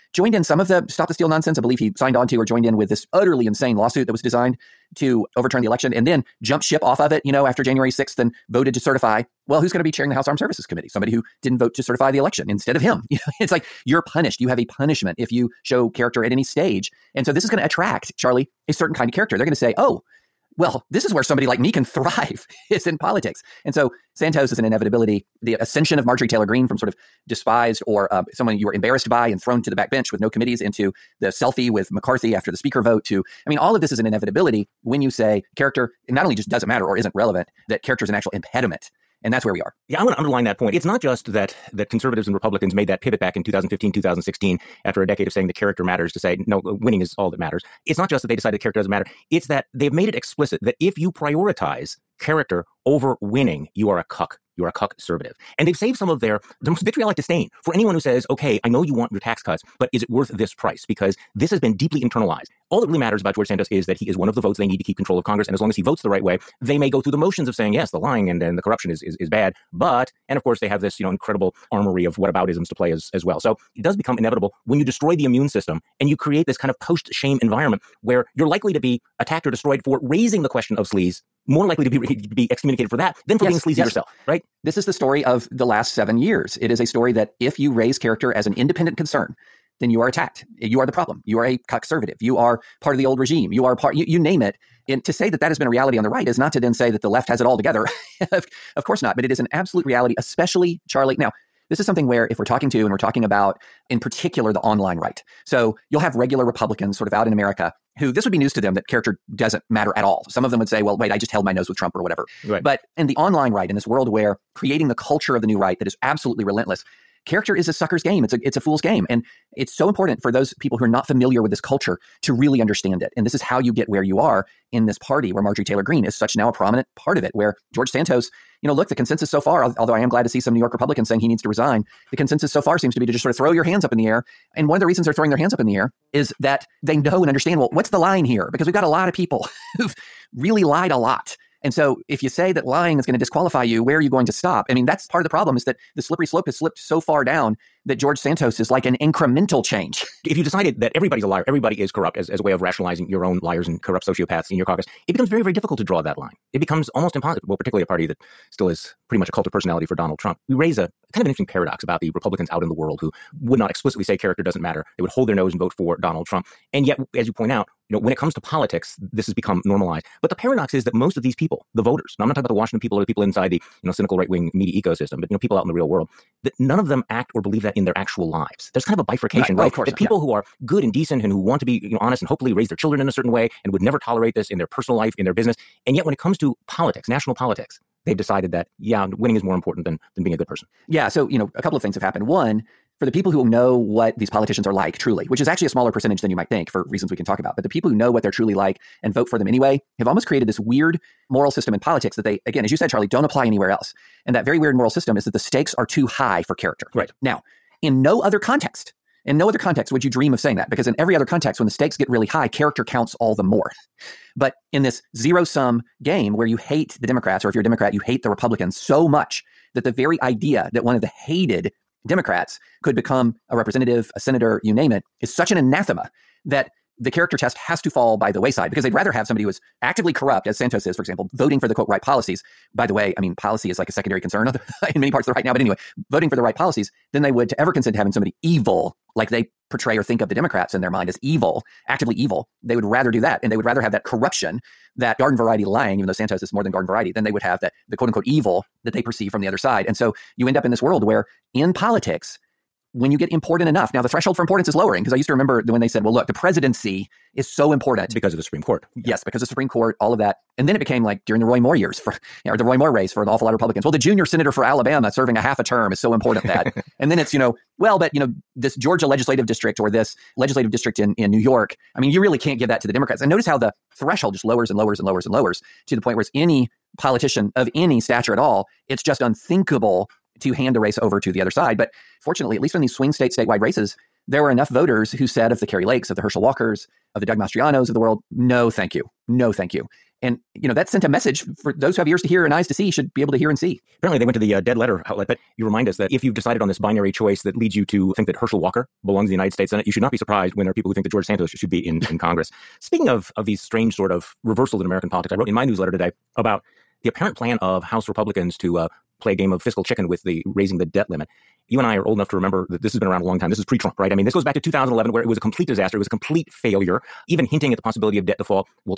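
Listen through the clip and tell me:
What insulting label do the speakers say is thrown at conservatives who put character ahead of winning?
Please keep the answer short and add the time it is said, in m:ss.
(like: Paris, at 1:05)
cuck conservative, at 0:54.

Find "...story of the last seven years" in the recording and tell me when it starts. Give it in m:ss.
1:24.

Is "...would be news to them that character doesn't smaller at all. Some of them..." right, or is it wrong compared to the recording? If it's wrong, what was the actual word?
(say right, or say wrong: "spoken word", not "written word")
wrong: "matter", not "smaller".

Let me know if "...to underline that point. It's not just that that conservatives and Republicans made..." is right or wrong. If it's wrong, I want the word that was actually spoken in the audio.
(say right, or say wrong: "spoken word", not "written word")
right.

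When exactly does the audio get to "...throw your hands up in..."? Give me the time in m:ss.
2:13.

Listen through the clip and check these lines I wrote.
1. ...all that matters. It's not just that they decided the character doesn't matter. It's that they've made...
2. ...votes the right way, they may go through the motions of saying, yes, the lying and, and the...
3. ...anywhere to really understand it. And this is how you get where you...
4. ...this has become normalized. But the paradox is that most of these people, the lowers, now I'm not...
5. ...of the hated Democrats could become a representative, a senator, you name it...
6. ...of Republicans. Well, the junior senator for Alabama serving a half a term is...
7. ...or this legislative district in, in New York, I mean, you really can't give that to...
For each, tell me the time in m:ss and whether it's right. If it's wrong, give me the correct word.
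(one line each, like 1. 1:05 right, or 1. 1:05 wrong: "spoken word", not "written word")
1. 0:47 right
2. 1:05 right
3. 2:01 wrong: "culture", not "anywhere"
4. 2:49 wrong: "voters", not "lowers"
5. 3:40 right
6. 4:23 right
7. 4:29 right.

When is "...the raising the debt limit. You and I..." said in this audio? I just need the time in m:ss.
5:10.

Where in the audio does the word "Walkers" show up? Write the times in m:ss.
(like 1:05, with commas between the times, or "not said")
4:46, 4:58.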